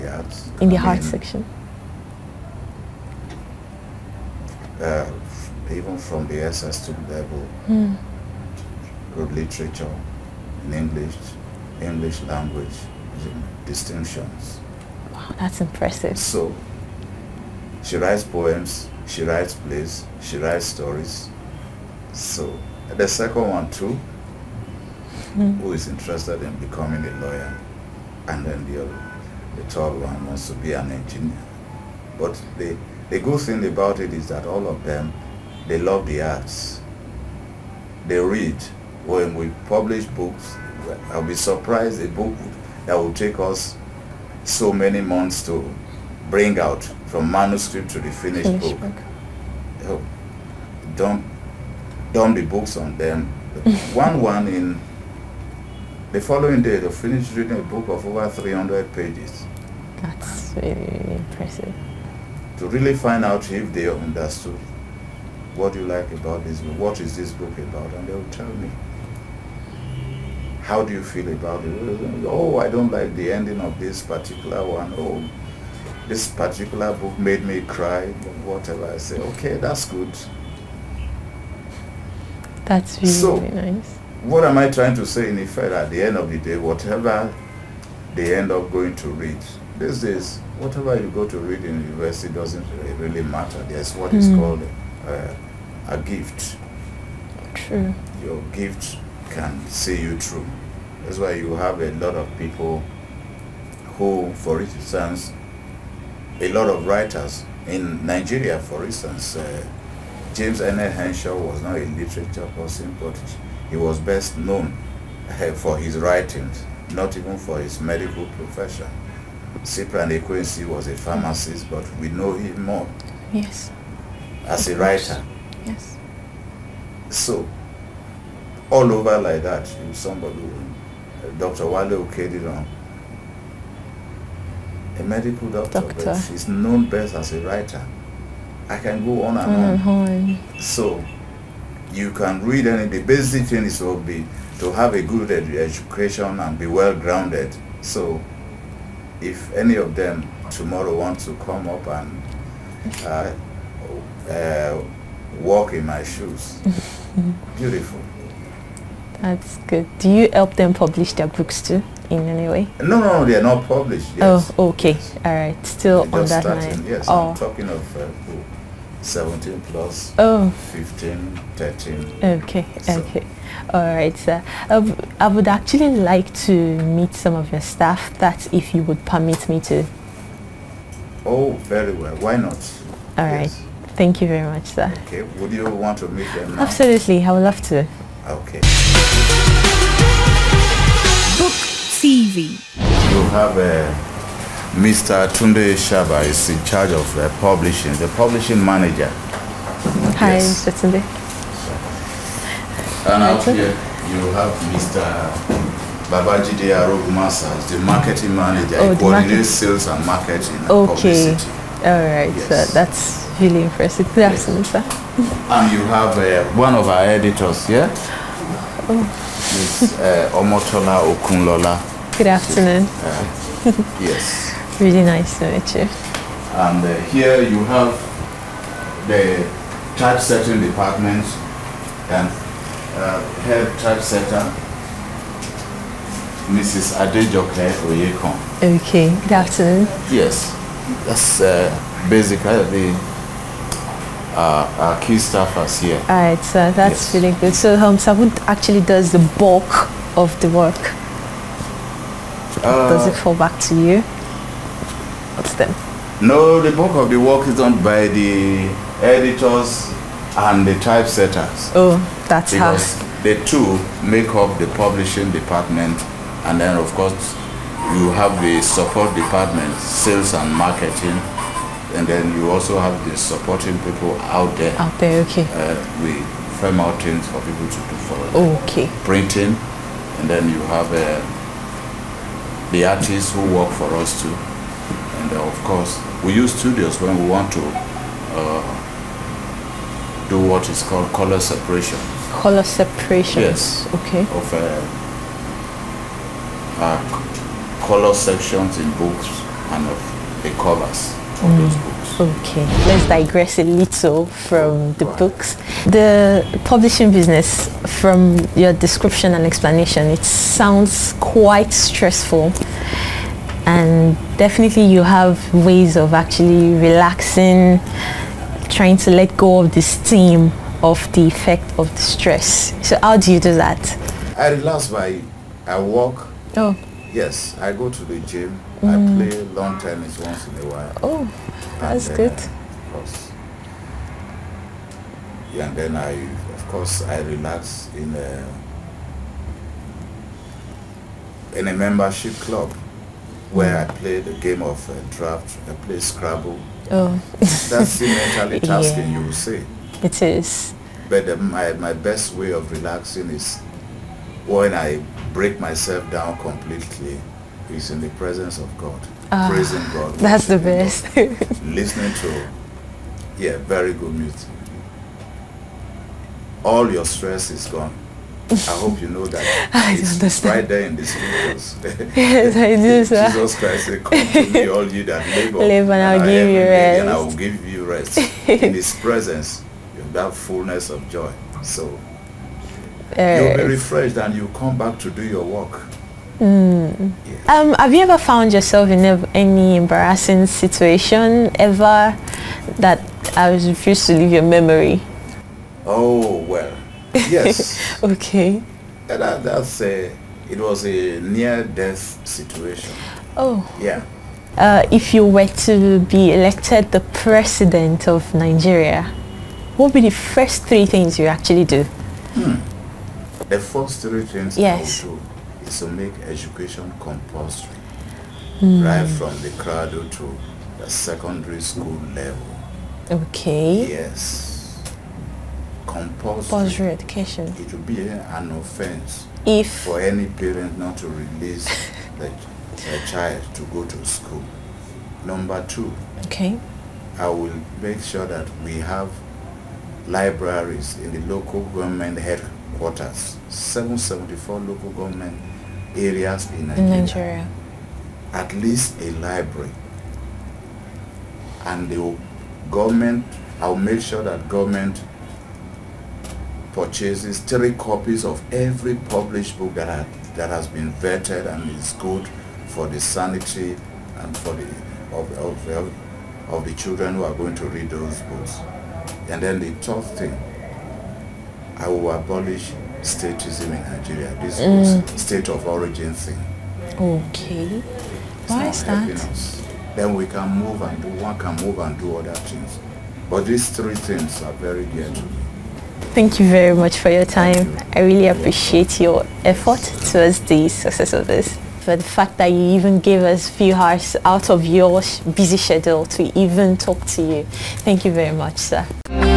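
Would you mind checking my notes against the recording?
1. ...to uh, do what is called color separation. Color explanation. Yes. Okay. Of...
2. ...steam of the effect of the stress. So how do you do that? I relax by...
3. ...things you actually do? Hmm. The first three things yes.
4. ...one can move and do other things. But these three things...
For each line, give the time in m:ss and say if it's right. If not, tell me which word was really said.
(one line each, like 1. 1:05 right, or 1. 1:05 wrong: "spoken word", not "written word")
1. 4:47 wrong: "separation", not "explanation"
2. 5:19 right
3. 6:50 right
4. 8:01 right.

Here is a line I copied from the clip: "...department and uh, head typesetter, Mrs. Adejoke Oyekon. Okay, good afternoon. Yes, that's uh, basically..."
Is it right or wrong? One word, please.
right.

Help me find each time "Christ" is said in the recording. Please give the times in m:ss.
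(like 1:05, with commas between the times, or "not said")
6:13.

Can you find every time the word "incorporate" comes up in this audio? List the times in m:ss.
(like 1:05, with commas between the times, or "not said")
not said.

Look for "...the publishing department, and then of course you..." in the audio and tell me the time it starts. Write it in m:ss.
4:24.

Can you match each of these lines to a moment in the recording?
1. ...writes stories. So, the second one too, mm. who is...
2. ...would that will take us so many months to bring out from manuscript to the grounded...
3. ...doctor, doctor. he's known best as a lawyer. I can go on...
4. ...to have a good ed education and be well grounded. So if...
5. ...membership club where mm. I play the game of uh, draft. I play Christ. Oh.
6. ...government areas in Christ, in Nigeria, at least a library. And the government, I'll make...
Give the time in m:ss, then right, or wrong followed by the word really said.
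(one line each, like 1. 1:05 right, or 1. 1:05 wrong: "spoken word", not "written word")
1. 0:20 right
2. 0:42 wrong: "finished", not "grounded"
3. 2:15 wrong: "writer", not "lawyer"
4. 2:24 right
5. 5:41 wrong: "Scrabble", not "Christ"
6. 7:24 wrong: "Nigeria", not "Christ".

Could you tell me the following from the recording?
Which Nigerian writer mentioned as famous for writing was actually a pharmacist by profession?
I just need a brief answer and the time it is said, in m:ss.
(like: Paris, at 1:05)
Cyprian Ekwensi, at 1:59.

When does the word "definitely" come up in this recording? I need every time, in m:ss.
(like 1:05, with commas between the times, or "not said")
5:14.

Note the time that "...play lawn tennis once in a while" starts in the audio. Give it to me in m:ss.
5:29.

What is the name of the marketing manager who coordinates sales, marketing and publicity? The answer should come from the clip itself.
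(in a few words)
Babajide Arogumasa.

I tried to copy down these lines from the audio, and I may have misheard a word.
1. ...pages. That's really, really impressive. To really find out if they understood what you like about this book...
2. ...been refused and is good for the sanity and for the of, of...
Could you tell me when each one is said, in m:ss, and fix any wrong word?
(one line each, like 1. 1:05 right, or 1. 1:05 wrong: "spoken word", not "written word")
1. 0:58 right
2. 7:40 wrong: "vetted", not "refused".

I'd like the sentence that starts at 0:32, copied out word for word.
But the, the good thing about it is that all of them, they love the arts.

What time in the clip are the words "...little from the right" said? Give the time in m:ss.
5:03.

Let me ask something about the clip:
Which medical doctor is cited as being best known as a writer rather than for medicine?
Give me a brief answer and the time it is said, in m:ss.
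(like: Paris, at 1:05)
Wale Okediran, at 2:11.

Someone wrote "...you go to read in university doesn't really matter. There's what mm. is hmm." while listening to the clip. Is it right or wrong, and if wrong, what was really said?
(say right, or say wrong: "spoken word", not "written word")
right.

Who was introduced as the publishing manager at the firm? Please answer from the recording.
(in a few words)
Tunde Shaba.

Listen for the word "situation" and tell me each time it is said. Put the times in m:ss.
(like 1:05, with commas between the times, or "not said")
6:30, 6:42.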